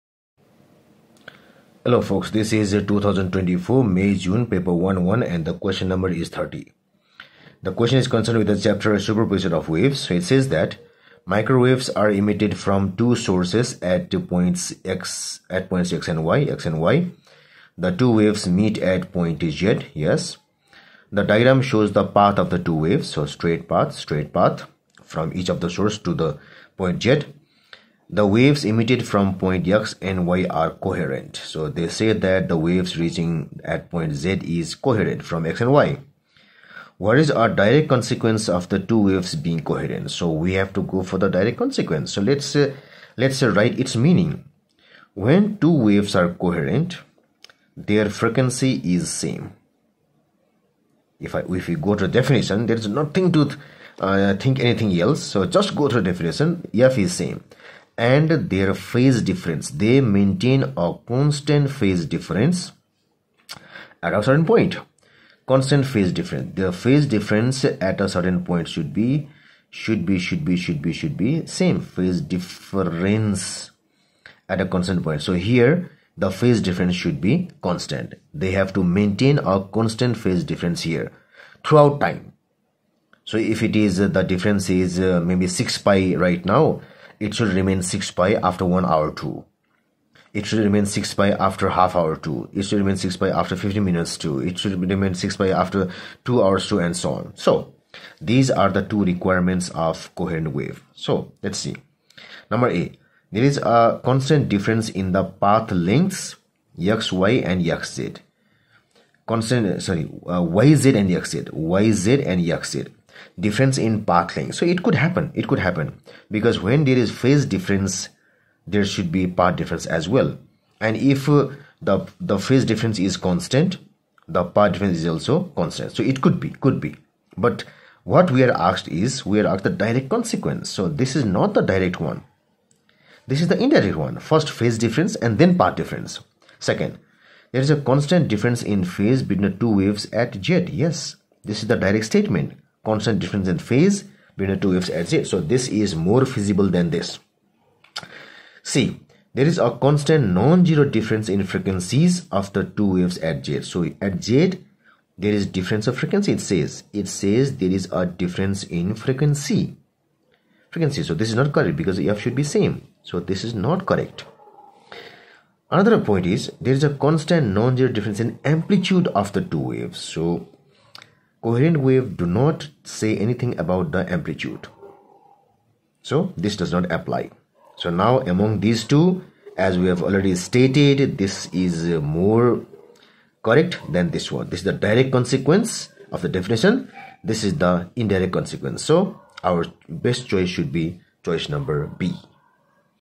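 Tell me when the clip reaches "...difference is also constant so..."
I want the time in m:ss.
2:04.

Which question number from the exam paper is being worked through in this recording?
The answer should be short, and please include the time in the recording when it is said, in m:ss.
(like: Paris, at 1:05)
30, at 0:06.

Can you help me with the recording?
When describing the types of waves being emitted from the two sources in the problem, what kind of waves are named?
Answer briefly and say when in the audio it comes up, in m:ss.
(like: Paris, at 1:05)
Microwaves, at 0:11.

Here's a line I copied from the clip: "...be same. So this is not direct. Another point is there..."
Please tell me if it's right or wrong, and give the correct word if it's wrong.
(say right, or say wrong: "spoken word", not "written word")
wrong: "correct", not "direct".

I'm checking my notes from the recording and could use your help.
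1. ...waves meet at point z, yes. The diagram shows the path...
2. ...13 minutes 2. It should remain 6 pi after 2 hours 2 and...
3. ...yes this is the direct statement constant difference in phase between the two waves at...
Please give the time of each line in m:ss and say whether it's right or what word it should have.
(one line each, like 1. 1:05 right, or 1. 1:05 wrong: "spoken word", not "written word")
1. 0:18 right
2. 1:33 wrong: "15", not "13"
3. 2:20 right.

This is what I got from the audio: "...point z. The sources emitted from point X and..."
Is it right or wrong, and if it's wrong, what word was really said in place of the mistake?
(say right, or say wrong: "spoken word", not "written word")
wrong: "waves", not "sources".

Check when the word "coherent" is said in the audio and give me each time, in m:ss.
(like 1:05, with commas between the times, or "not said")
0:30, 0:34, 0:39, 0:46, 1:40, 2:51.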